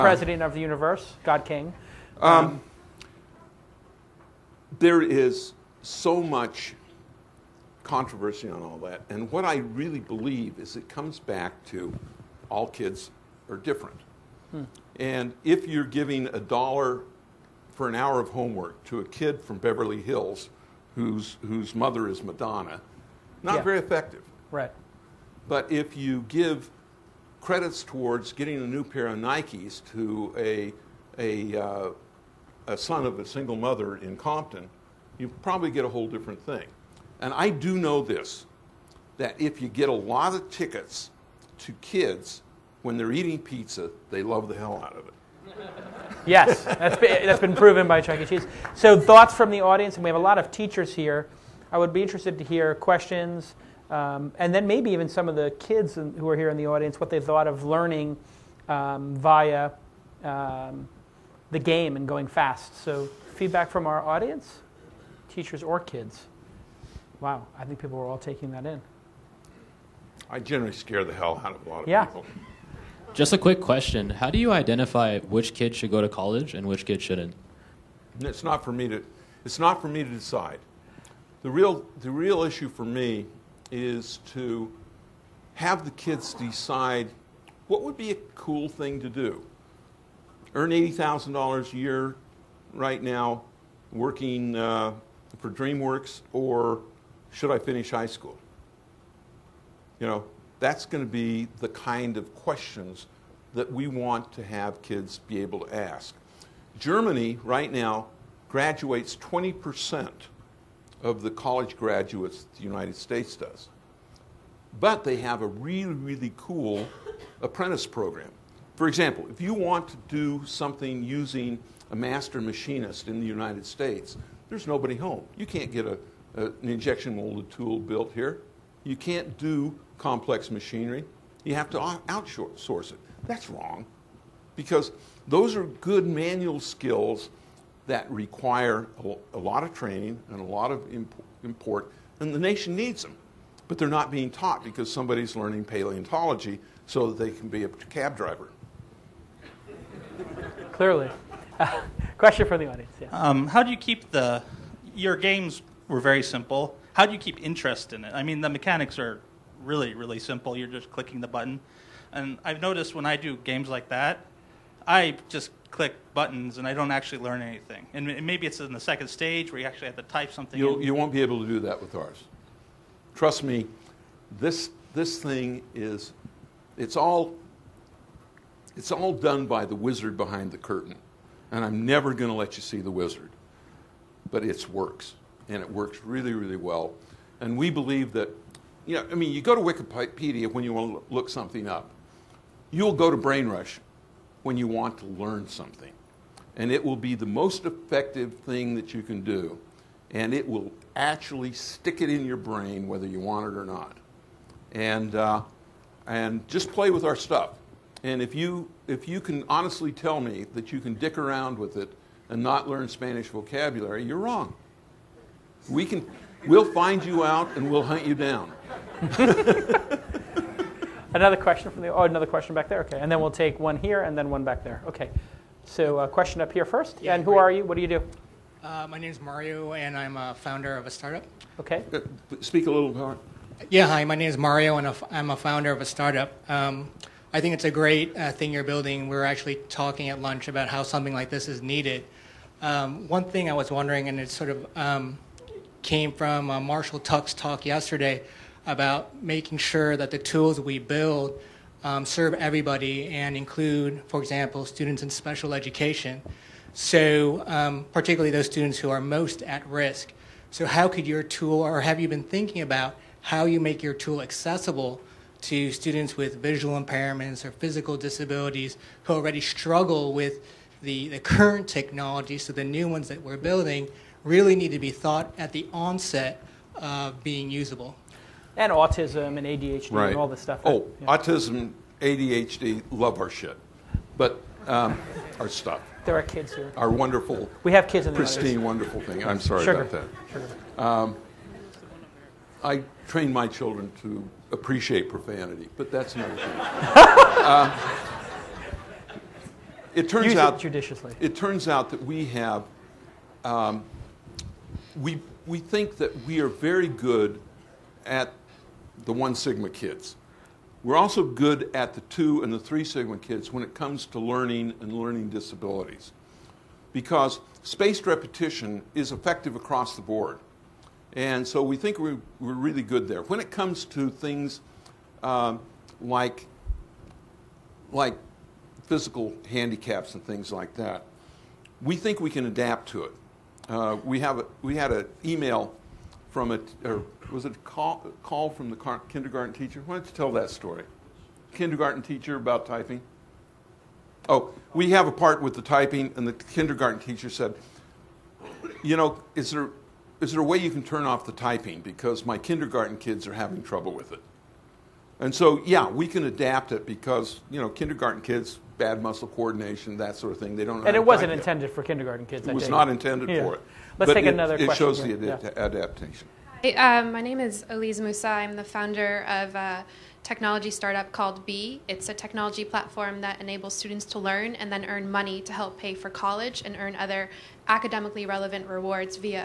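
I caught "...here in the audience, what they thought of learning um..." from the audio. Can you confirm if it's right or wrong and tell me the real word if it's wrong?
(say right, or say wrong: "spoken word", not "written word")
right.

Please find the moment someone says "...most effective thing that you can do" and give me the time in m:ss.
3:17.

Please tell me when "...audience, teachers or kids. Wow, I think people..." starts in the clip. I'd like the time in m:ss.
1:04.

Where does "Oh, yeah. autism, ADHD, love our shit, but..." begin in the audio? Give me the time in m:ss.
4:40.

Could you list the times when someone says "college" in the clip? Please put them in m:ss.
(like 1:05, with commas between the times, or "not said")
1:16, 1:51, 6:16.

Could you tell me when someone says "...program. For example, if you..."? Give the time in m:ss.
1:57.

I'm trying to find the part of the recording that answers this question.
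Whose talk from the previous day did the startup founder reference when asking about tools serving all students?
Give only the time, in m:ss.
4:06.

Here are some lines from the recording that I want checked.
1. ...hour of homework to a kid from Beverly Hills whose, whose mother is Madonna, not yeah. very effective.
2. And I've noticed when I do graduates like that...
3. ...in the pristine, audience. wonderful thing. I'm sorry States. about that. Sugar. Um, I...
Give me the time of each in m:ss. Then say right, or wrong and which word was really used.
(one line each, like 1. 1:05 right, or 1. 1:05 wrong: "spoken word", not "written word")
1. 0:17 right
2. 2:42 wrong: "games", not "graduates"
3. 4:48 wrong: "Sugar", not "States".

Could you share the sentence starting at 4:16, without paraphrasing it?
So, um, particularly those students who are most at risk.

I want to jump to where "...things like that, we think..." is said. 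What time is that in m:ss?
5:30.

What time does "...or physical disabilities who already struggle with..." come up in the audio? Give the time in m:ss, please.
4:27.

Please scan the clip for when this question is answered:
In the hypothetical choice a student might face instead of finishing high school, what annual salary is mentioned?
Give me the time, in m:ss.
1:30.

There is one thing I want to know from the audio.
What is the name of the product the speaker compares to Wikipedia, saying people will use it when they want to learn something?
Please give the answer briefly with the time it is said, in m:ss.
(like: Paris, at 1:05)
Brainrush, at 3:13.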